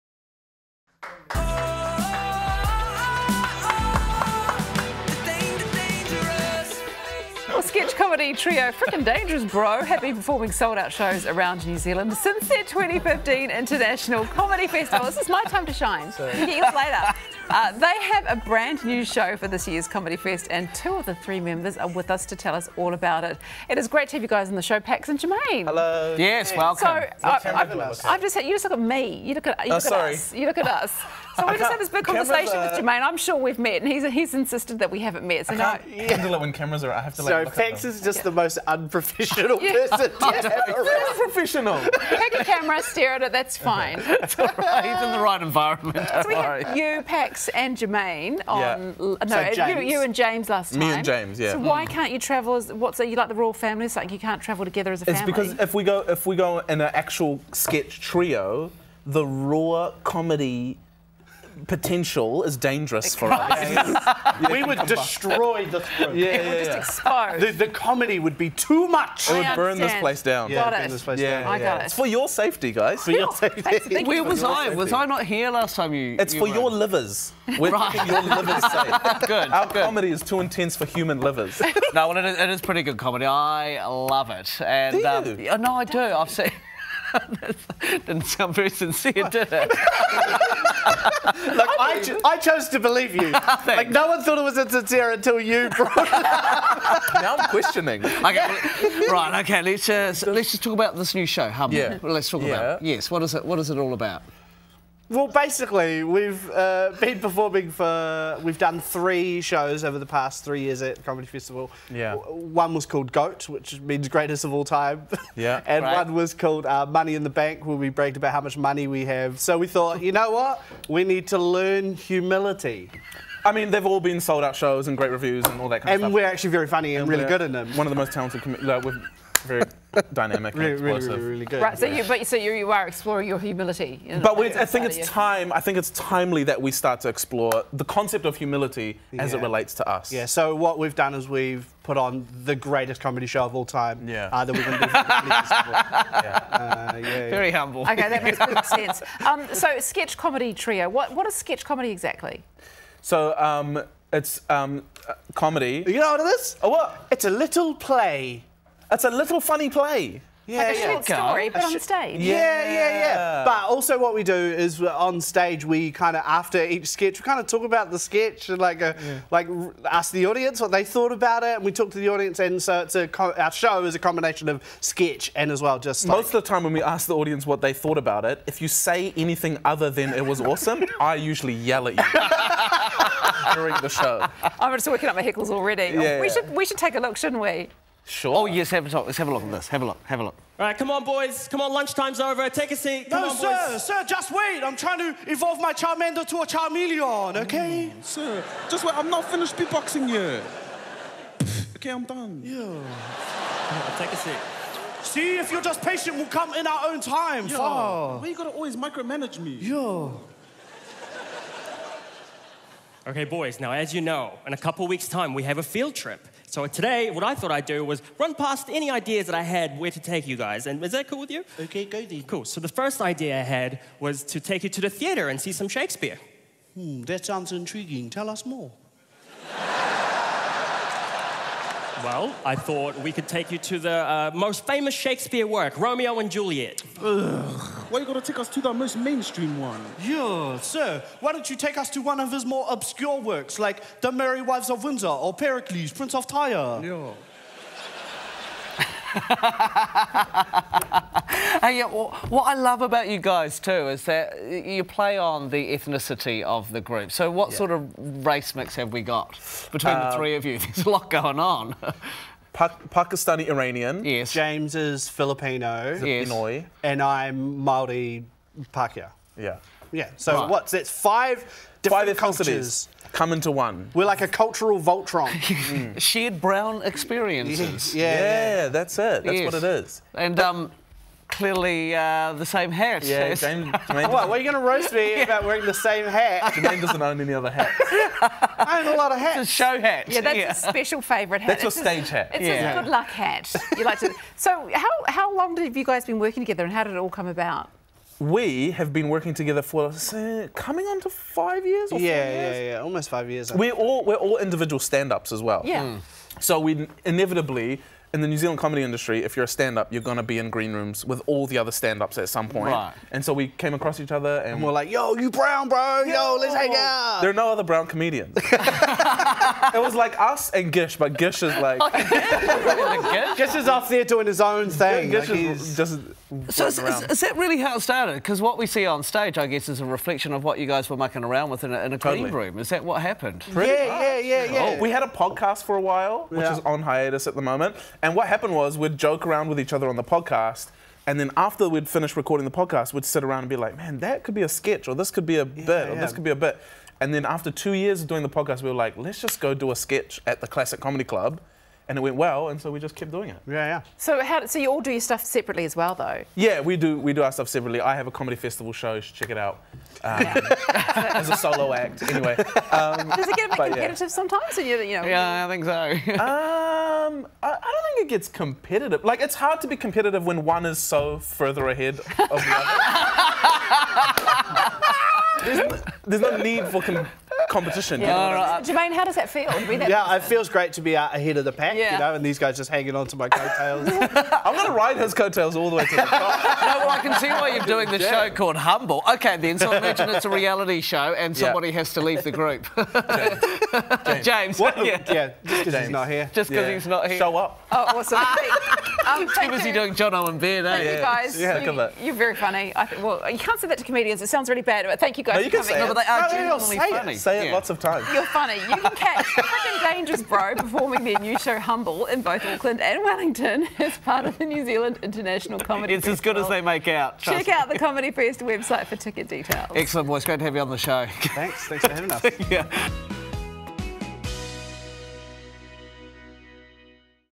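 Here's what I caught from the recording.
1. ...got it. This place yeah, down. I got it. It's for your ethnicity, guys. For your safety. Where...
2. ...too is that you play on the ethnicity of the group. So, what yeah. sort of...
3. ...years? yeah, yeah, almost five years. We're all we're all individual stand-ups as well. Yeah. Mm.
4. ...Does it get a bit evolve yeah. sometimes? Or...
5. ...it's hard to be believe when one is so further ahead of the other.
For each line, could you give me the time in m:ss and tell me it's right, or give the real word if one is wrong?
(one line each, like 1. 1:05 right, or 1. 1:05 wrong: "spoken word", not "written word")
1. 1:10 wrong: "safety", not "ethnicity"
2. 4:13 right
3. 5:01 right
4. 6:03 wrong: "competitive", not "evolve"
5. 6:09 wrong: "competitive", not "believe".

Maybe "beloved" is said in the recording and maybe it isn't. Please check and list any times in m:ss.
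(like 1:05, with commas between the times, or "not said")
not said.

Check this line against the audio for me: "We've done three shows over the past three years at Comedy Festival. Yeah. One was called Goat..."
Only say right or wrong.
right.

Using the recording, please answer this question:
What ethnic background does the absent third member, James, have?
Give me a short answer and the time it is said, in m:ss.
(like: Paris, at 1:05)
Filipino, at 4:25.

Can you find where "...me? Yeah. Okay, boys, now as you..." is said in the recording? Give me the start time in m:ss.
3:29.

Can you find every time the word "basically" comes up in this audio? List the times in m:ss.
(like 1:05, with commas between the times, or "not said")
1:45.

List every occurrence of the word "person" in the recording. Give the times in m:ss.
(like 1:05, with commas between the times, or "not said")
0:39, 6:20.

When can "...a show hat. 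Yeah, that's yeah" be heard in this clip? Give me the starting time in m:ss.
4:49.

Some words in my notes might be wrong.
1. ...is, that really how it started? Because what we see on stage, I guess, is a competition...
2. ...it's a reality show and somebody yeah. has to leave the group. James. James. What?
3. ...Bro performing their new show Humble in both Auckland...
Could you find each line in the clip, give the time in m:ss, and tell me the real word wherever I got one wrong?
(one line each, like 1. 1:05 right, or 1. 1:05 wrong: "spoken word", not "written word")
1. 5:27 wrong: "reflection", not "competition"
2. 6:30 right
3. 6:50 right.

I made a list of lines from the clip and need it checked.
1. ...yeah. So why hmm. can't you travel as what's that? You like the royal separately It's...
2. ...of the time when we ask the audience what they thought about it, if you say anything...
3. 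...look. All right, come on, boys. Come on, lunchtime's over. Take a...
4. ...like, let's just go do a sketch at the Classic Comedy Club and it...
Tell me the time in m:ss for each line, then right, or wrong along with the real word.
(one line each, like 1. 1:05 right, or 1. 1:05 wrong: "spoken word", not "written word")
1. 0:51 wrong: "family", not "separately"
2. 2:56 right
3. 3:10 right
4. 5:48 right.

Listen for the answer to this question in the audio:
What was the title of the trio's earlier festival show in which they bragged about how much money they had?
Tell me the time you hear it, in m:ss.
1:56.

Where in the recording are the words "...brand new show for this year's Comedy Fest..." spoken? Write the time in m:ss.
0:18.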